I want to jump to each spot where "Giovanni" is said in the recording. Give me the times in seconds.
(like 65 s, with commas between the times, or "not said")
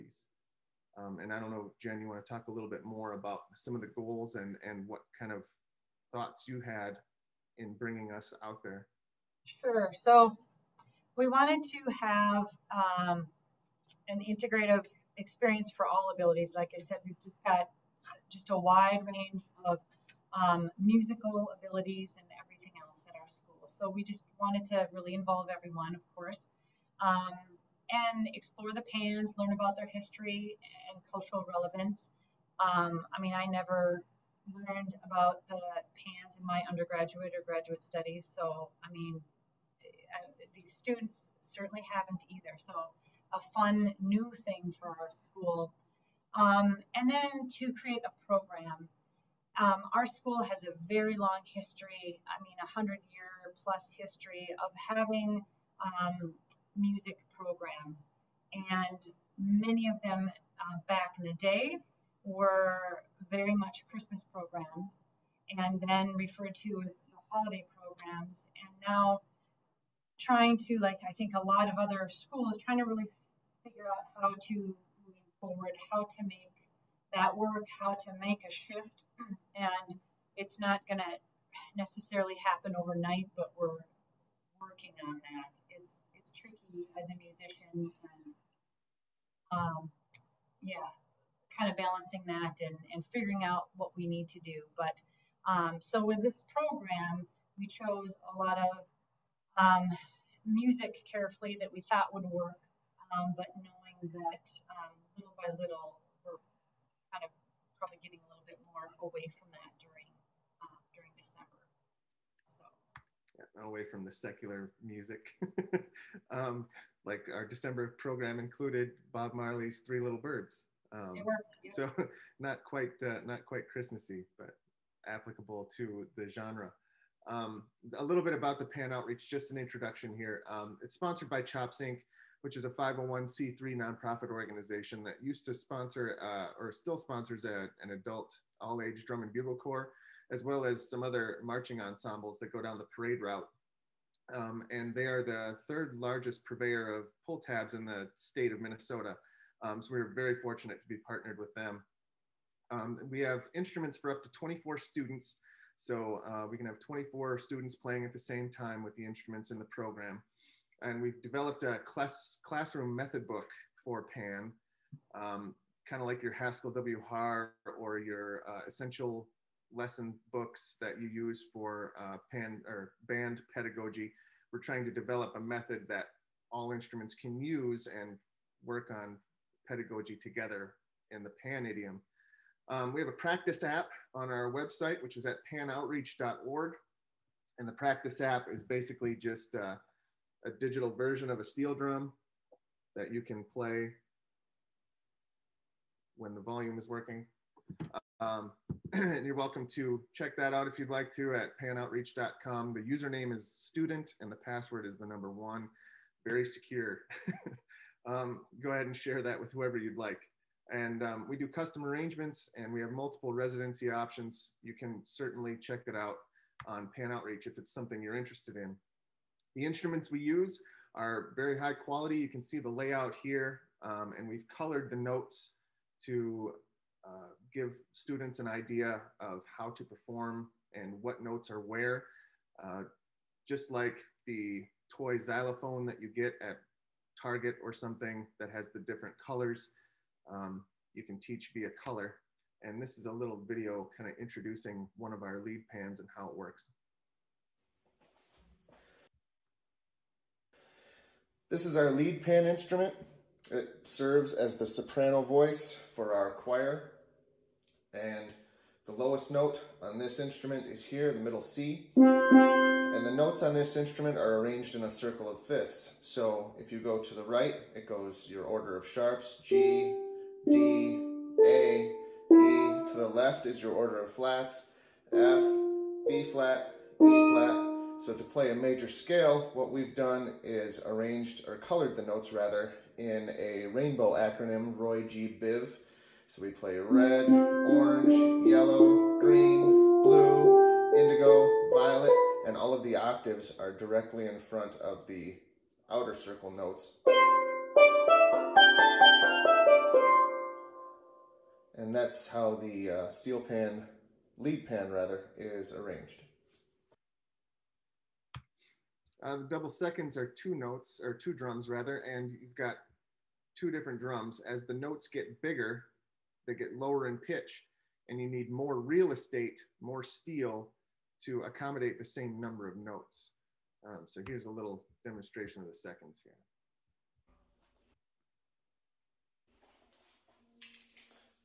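not said.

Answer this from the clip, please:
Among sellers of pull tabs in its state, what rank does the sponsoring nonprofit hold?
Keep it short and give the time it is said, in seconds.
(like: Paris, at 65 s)
Third largest, at 145 s.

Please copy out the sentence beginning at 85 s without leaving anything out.
It's it's tricky as a musician, and um, yeah, kind of balancing that and, and figuring out what we need to do.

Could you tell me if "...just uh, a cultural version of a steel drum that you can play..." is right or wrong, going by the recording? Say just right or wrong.
wrong.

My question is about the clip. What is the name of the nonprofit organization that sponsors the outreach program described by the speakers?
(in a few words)
CHOPS Inc.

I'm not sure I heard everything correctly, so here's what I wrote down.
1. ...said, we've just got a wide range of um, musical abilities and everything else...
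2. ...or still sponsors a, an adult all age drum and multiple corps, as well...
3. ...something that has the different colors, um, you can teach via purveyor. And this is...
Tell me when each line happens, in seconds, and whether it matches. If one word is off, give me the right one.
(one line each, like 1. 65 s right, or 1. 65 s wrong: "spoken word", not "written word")
1. 16 s right
2. 136 s wrong: "bugle", not "multiple"
3. 237 s wrong: "color", not "purveyor".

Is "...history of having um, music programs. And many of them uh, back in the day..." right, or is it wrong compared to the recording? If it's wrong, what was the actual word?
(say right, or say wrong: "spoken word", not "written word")
right.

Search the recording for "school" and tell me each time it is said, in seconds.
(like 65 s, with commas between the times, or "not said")
23 s, 45 s, 50 s, 72 s.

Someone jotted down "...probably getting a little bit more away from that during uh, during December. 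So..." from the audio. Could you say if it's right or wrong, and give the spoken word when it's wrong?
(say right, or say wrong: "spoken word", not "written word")
right.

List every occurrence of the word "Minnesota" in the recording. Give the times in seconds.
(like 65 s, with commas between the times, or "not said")
148 s.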